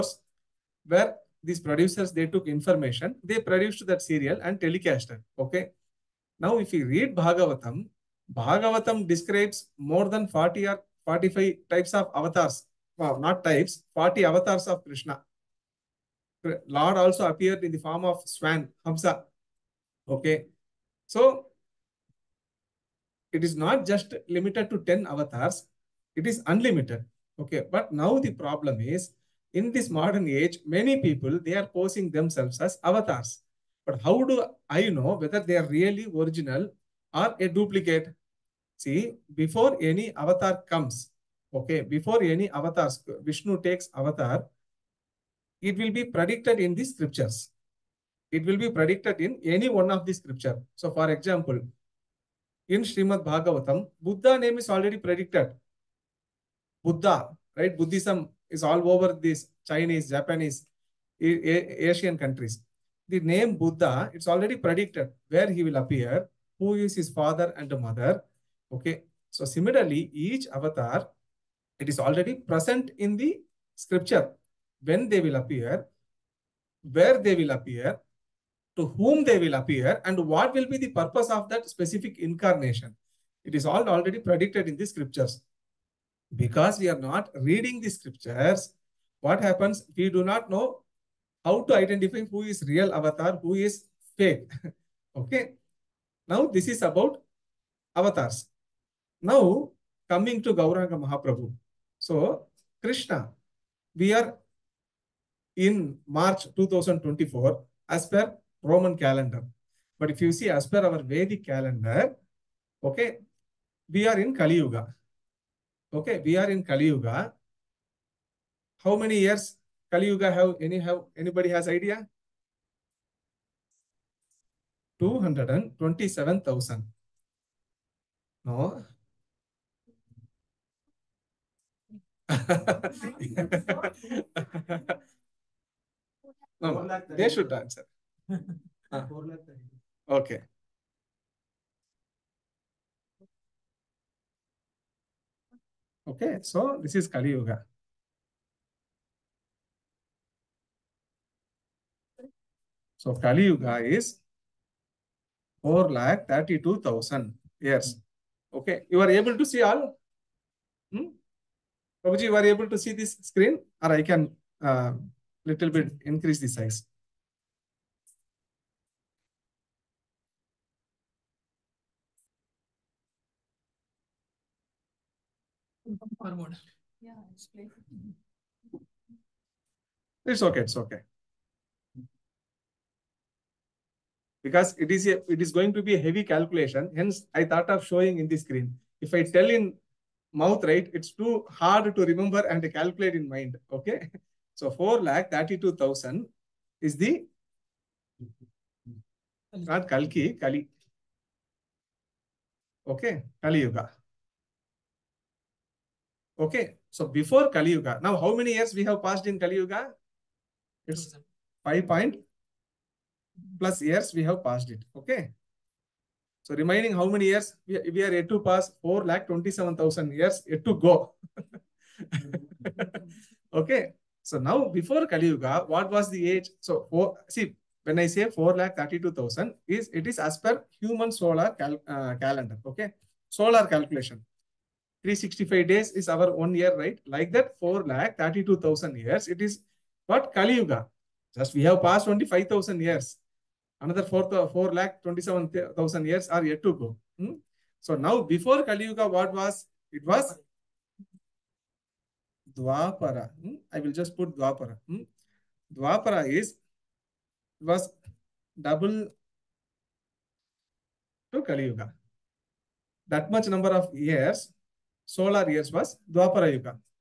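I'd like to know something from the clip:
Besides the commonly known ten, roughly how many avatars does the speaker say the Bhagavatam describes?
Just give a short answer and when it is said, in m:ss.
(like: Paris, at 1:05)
40, at 0:13.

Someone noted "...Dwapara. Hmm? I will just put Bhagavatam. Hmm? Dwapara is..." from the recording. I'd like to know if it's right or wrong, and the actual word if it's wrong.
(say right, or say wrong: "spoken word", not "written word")
wrong: "Dwapara", not "Bhagavatam".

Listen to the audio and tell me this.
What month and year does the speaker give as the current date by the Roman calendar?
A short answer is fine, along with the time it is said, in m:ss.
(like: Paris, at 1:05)
March 2024, at 1:46.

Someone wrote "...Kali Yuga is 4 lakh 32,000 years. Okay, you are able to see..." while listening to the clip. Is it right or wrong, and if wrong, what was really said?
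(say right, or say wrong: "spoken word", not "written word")
right.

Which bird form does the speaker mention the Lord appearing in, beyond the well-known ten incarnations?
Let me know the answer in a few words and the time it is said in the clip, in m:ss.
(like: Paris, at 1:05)
Swan (Hamsa), at 0:18.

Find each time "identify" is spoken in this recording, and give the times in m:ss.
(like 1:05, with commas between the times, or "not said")
1:31.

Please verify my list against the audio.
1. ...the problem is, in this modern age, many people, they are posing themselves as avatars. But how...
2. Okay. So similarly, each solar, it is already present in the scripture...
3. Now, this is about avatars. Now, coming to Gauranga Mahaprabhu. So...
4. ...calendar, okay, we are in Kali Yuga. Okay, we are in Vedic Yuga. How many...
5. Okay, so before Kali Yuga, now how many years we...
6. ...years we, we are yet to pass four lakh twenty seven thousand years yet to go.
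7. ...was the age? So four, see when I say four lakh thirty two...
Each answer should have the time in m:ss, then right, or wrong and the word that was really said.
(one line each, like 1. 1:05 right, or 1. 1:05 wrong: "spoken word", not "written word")
1. 0:28 right
2. 1:08 wrong: "avatar", not "solar"
3. 1:36 right
4. 1:51 wrong: "Kali", not "Vedic"
5. 3:26 right
6. 3:37 right
7. 3:45 right.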